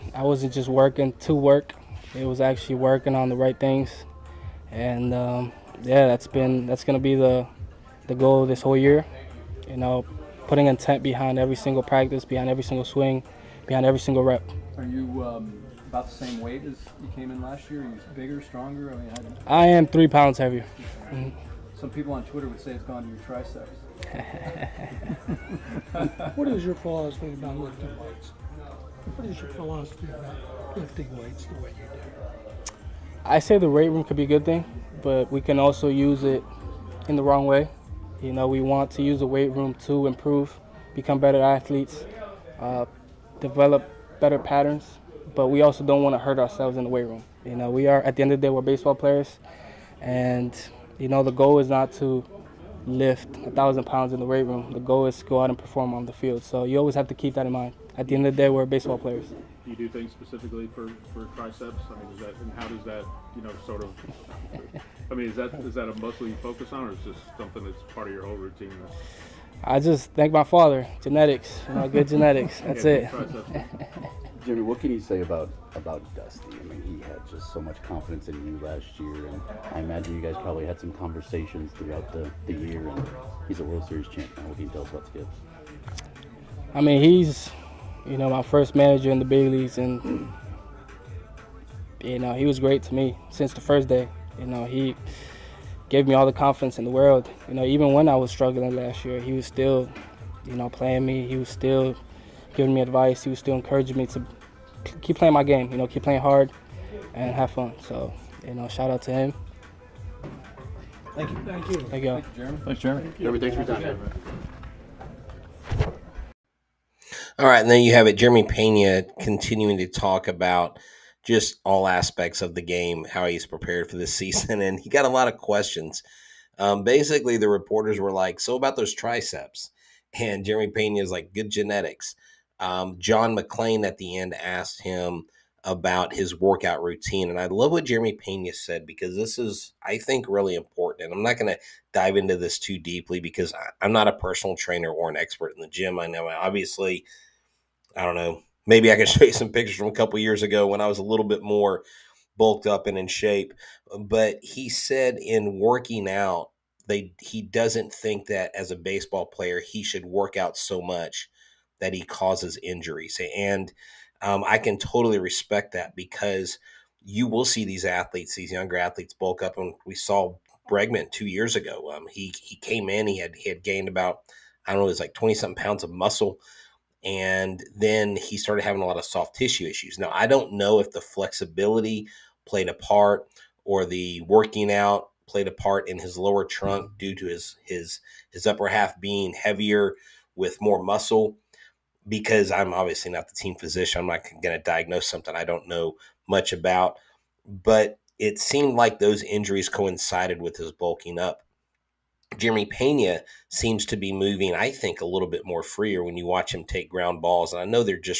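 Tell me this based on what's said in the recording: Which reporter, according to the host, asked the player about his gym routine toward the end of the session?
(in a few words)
John McClain.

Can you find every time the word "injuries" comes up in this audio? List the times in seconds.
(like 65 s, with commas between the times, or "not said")
162 s, 199 s.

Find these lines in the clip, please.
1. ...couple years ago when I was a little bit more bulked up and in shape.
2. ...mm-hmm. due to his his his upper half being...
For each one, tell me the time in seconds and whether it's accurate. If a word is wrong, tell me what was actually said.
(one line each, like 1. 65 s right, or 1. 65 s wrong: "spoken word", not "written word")
1. 149 s right
2. 186 s right.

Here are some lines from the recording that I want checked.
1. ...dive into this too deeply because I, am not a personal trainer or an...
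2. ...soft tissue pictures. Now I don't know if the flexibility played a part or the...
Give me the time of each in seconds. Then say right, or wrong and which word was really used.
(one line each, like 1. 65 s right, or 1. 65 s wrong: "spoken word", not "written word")
1. 141 s right
2. 179 s wrong: "issues", not "pictures".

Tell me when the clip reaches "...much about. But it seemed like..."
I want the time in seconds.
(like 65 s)
196 s.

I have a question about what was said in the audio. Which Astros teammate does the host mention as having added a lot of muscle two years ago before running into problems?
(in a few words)
Bregman.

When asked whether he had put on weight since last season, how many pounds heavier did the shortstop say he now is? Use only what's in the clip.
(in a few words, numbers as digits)
3.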